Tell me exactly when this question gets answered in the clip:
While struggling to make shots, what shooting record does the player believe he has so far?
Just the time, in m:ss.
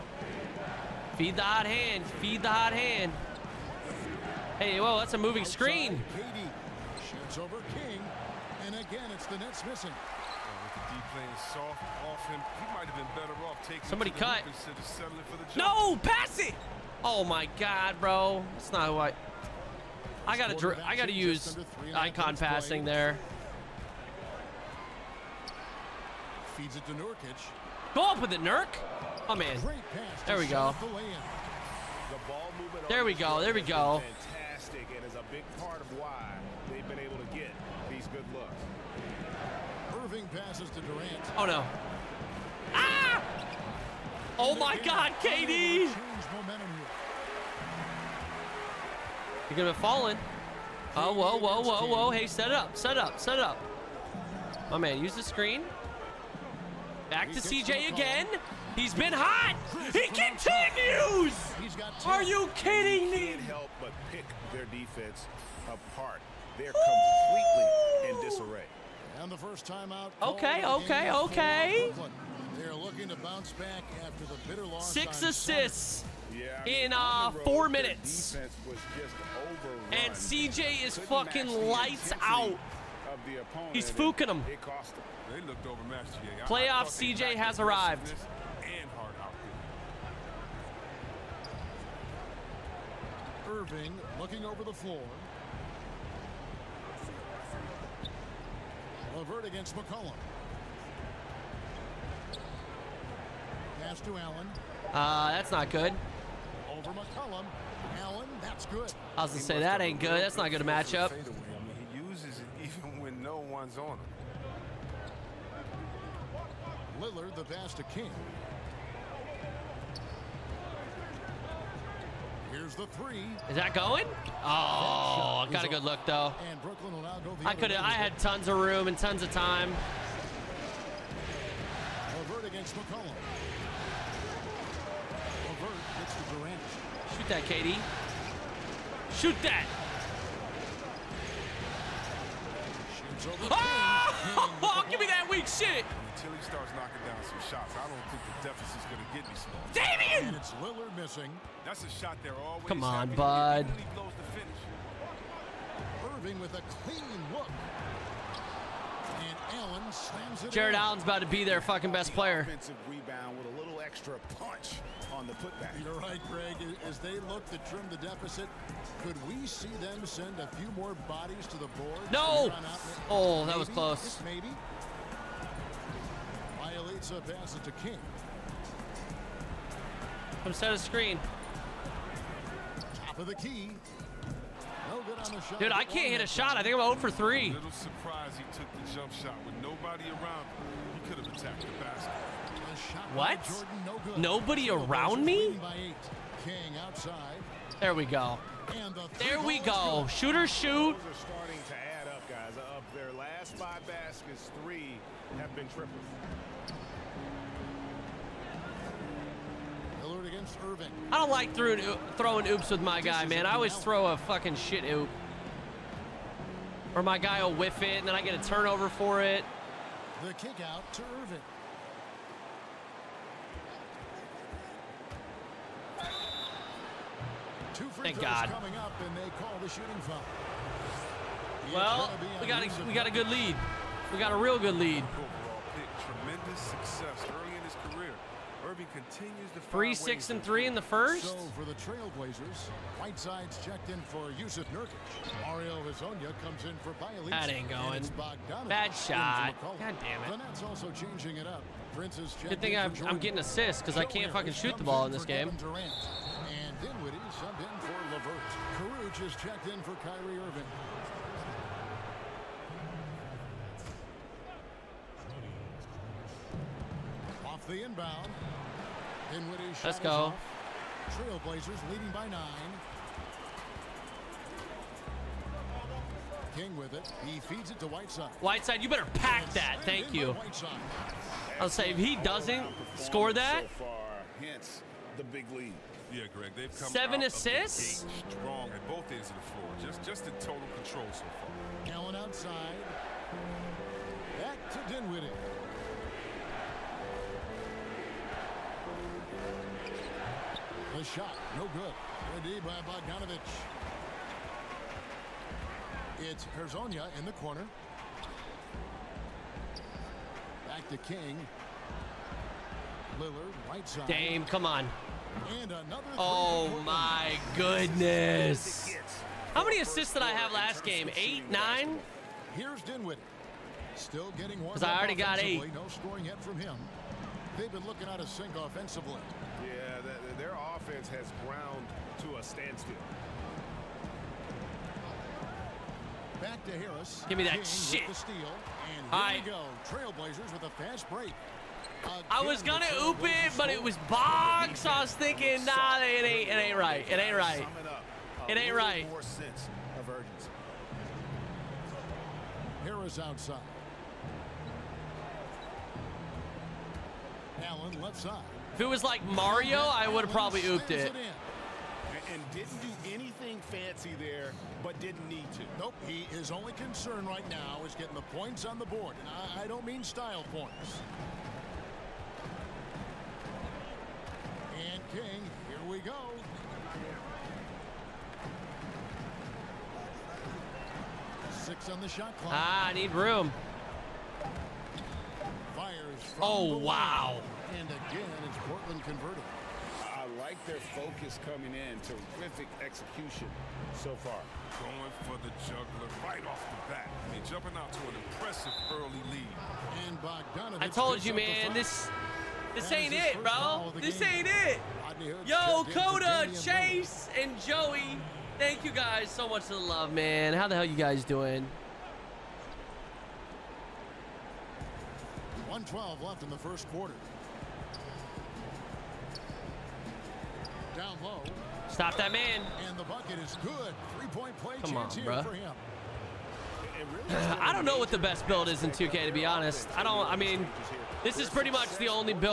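3:06.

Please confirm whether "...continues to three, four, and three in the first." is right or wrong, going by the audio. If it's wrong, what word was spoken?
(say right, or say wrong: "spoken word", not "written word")
wrong: "six", not "four".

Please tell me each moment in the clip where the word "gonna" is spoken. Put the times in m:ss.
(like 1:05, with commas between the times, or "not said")
0:49, 5:42.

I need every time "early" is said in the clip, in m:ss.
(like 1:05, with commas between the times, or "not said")
3:57, 6:38.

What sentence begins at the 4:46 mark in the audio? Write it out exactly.
Yeah, Greg, they've come seven assists.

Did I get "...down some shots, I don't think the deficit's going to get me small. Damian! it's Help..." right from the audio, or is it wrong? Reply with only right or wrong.
wrong.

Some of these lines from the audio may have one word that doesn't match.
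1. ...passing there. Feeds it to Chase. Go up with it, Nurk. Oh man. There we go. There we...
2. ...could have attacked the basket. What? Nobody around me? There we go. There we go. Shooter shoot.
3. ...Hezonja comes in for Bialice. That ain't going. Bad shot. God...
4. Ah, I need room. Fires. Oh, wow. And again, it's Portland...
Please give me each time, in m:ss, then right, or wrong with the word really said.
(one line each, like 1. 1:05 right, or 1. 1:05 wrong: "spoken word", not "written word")
1. 0:22 wrong: "Nurkic", not "Chase"
2. 3:11 right
3. 4:05 right
4. 6:22 right.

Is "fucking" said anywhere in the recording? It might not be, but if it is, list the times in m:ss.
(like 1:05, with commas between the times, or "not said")
1:20, 2:41, 3:34, 4:14.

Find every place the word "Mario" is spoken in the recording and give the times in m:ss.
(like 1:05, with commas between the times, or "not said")
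4:05, 5:59.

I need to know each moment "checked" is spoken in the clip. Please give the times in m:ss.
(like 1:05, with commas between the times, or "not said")
4:03, 4:19.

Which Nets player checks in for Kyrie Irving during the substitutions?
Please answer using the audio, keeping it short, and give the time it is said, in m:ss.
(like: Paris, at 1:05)
Kurucs, at 4:18.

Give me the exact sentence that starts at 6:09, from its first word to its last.
And I, I don't mean style points.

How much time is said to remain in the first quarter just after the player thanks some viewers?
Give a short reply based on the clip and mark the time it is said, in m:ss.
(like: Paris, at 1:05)
1:12, at 6:55.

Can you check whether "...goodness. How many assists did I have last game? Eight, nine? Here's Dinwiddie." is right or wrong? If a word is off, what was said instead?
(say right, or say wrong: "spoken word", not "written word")
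right.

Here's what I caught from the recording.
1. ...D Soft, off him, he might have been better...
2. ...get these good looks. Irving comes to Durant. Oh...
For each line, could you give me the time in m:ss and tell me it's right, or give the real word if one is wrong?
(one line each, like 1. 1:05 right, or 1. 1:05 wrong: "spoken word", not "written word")
1. 0:10 right
2. 0:37 wrong: "passes", not "comes".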